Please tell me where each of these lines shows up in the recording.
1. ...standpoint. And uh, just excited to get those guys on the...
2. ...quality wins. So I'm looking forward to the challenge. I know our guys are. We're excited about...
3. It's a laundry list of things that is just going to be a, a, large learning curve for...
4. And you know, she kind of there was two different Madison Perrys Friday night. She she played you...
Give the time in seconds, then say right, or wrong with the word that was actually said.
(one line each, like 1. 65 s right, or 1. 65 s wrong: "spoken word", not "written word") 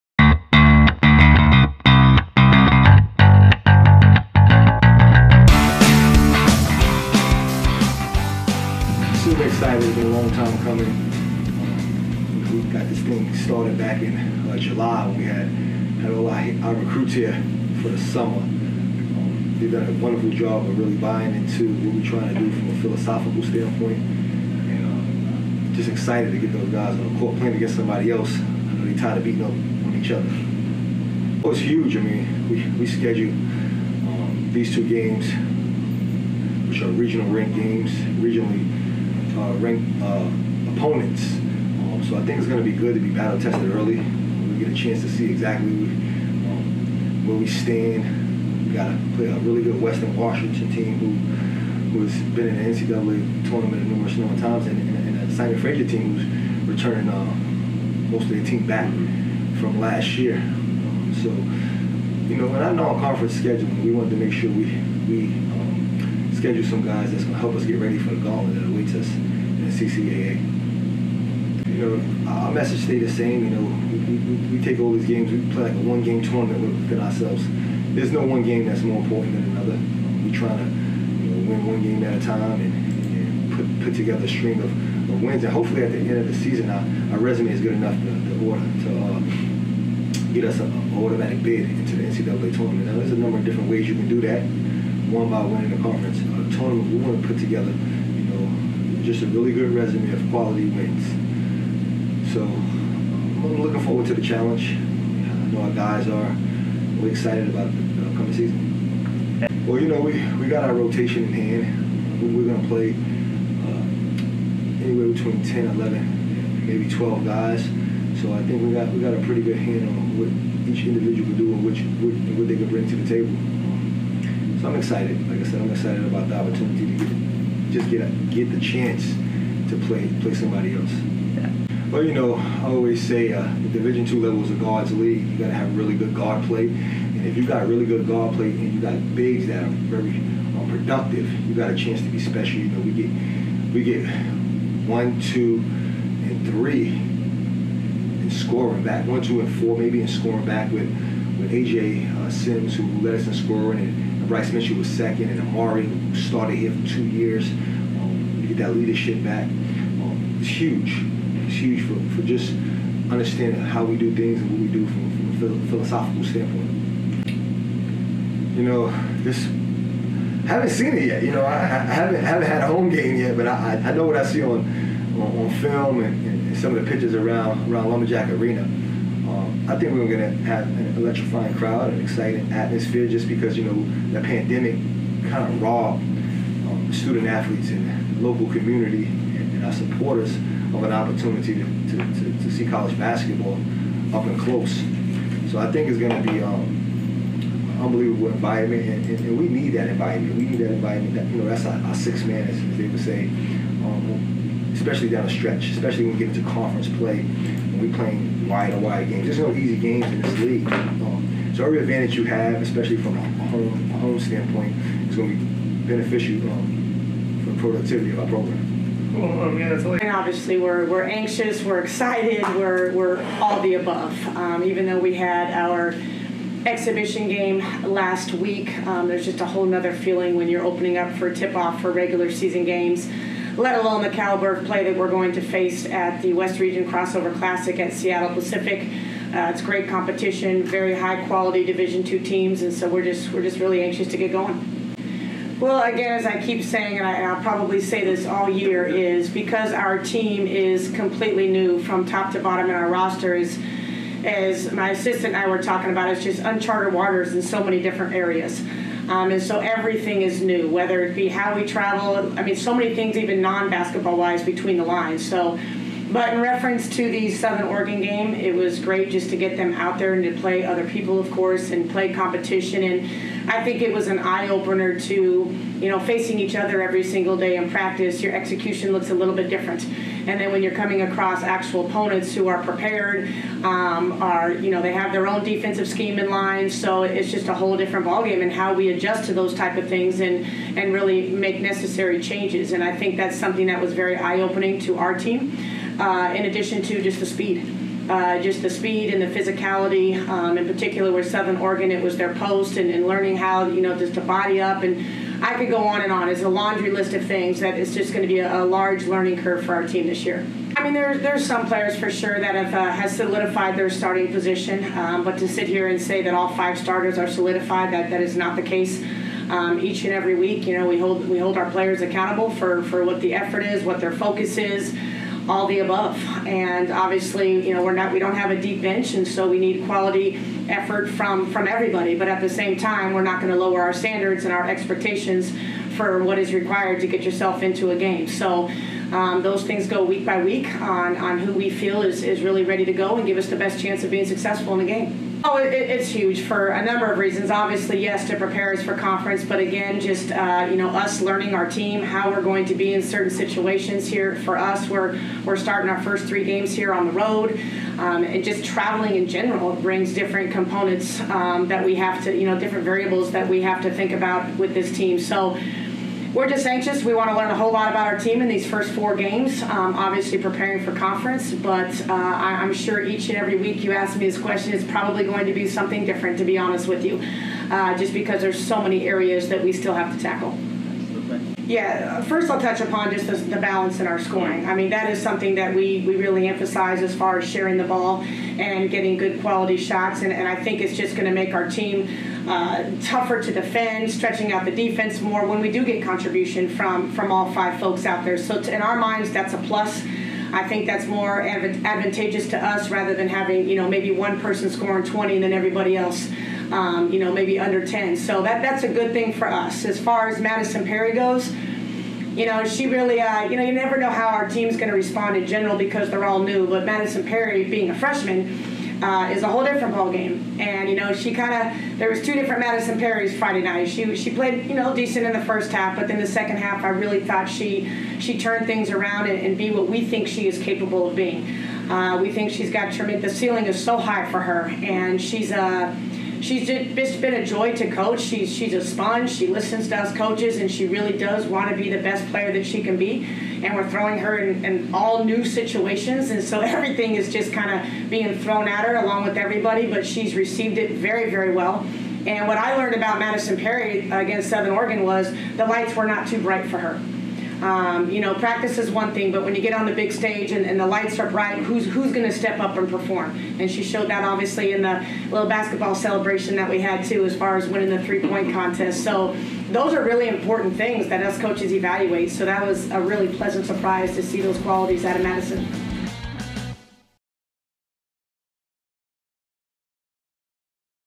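1. 23 s right
2. 100 s right
3. 306 s right
4. 420 s right.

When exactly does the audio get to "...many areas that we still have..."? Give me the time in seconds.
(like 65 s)
378 s.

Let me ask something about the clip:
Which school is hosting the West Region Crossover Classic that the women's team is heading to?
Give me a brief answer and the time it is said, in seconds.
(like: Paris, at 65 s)
Seattle Pacific, at 237 s.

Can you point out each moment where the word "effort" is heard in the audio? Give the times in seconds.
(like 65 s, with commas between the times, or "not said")
323 s, 330 s.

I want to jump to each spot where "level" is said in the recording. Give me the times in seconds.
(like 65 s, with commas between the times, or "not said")
134 s.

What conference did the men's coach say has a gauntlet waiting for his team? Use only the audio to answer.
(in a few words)
CCAA.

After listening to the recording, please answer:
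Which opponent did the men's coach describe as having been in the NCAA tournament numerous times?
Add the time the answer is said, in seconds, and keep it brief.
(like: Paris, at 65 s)
Western Washington, at 49 s.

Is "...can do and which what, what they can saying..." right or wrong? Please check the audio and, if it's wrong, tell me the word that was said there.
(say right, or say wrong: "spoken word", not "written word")
wrong: "bring", not "saying".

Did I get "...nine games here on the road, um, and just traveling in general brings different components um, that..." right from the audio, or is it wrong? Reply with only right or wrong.
wrong.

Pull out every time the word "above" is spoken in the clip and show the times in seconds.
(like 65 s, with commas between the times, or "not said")
223 s, 325 s.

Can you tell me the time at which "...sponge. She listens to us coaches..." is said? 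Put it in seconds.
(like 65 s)
438 s.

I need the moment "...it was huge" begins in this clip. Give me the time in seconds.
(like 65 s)
31 s.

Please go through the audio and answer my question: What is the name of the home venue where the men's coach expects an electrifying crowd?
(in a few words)
Lumberjack Arena.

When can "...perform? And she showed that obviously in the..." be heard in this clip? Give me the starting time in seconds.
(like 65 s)
462 s.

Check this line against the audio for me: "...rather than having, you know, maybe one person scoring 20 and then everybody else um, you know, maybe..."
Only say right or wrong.
right.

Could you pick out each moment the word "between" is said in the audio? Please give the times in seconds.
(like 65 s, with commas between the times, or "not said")
115 s, 264 s.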